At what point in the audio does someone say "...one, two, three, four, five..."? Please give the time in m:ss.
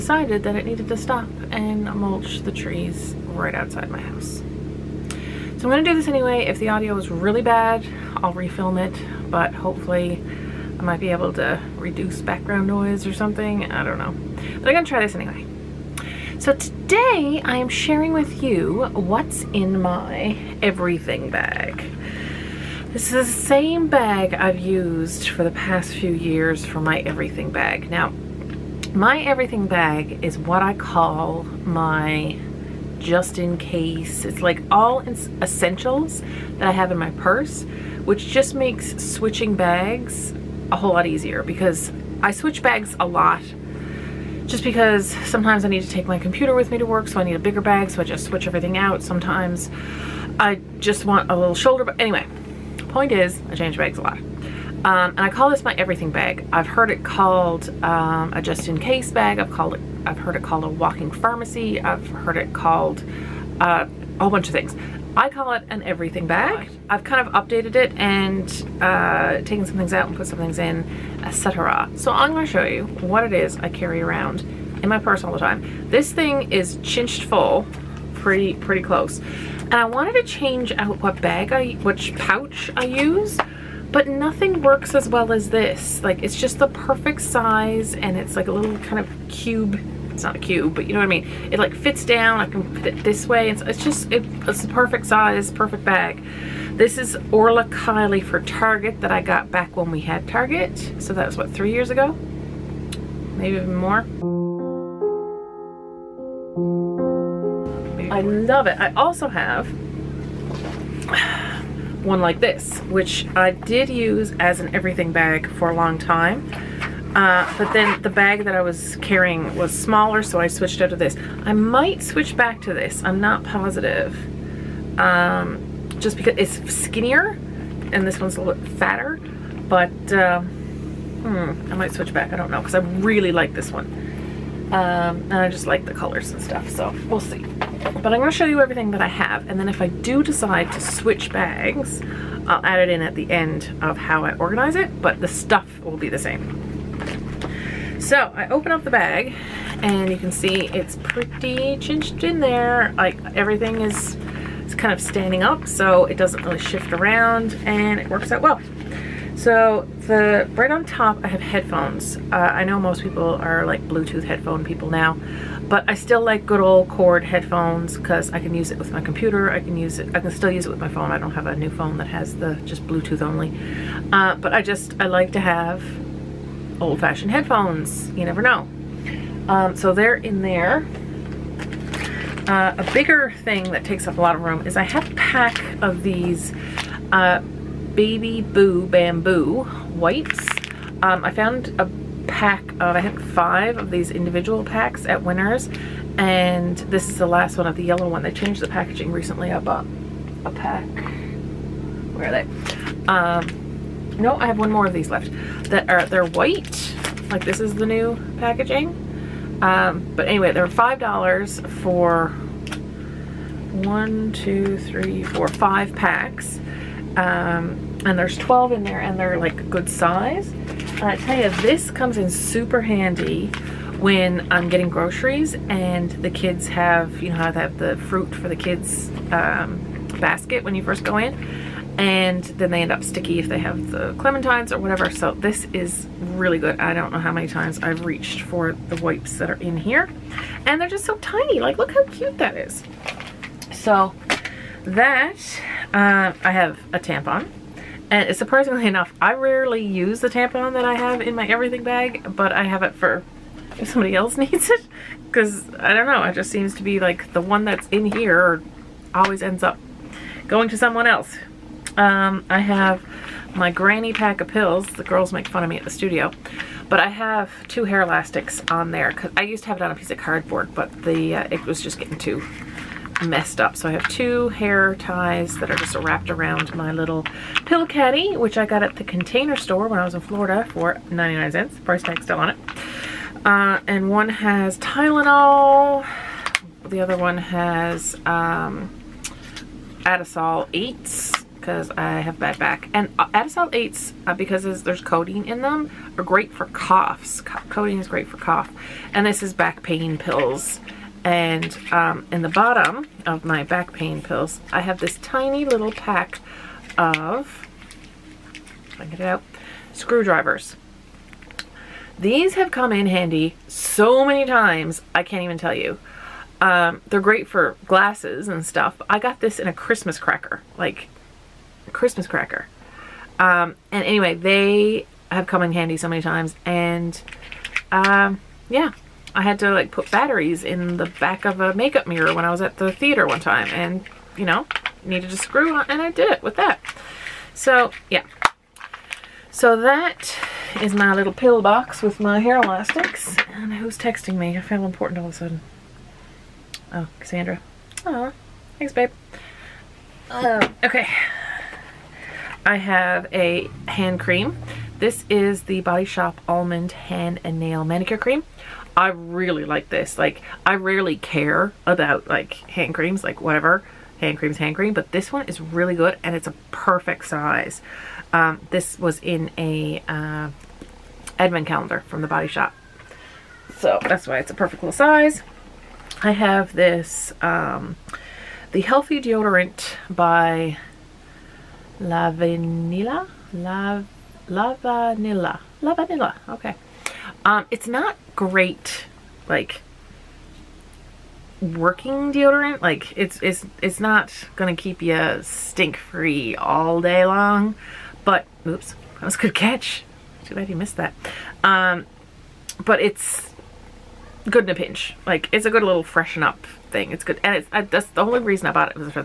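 3:33.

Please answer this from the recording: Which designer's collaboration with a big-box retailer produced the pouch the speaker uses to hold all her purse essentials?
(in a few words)
Orla Kiely.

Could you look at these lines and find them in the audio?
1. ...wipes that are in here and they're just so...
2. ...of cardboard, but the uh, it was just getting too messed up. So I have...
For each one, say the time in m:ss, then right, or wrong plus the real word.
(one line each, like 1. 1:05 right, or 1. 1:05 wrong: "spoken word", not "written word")
1. 3:58 right
2. 4:30 right.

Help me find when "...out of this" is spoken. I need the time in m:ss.
2:00.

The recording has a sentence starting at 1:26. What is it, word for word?
Like it's just the perfect size and it's like a little kind of cube.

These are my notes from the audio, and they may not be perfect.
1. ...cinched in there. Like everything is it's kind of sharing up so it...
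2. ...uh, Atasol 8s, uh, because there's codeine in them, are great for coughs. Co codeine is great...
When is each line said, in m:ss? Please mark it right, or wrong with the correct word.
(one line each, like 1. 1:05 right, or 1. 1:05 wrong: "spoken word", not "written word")
1. 2:31 wrong: "standing", not "sharing"
2. 4:53 right.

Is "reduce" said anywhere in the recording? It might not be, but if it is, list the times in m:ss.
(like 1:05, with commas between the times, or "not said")
0:11.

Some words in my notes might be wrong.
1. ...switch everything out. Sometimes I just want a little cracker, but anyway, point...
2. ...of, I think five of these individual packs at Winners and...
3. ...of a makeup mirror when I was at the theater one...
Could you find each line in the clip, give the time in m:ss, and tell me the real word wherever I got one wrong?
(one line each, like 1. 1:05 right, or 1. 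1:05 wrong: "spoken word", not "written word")
1. 0:48 wrong: "shoulder", not "cracker"
2. 3:12 right
3. 5:31 right.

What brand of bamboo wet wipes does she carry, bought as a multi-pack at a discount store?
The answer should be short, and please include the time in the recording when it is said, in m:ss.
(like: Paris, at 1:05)
Baby Boo Bamboo, at 3:07.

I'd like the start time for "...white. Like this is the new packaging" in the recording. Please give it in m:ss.
3:26.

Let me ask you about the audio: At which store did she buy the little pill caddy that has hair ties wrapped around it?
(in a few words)
the Container Store.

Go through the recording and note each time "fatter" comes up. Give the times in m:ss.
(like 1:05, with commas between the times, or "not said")
2:08.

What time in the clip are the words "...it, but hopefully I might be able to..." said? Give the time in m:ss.
0:08.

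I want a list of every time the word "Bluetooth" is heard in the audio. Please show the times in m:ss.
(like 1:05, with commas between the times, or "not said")
2:43, 2:52.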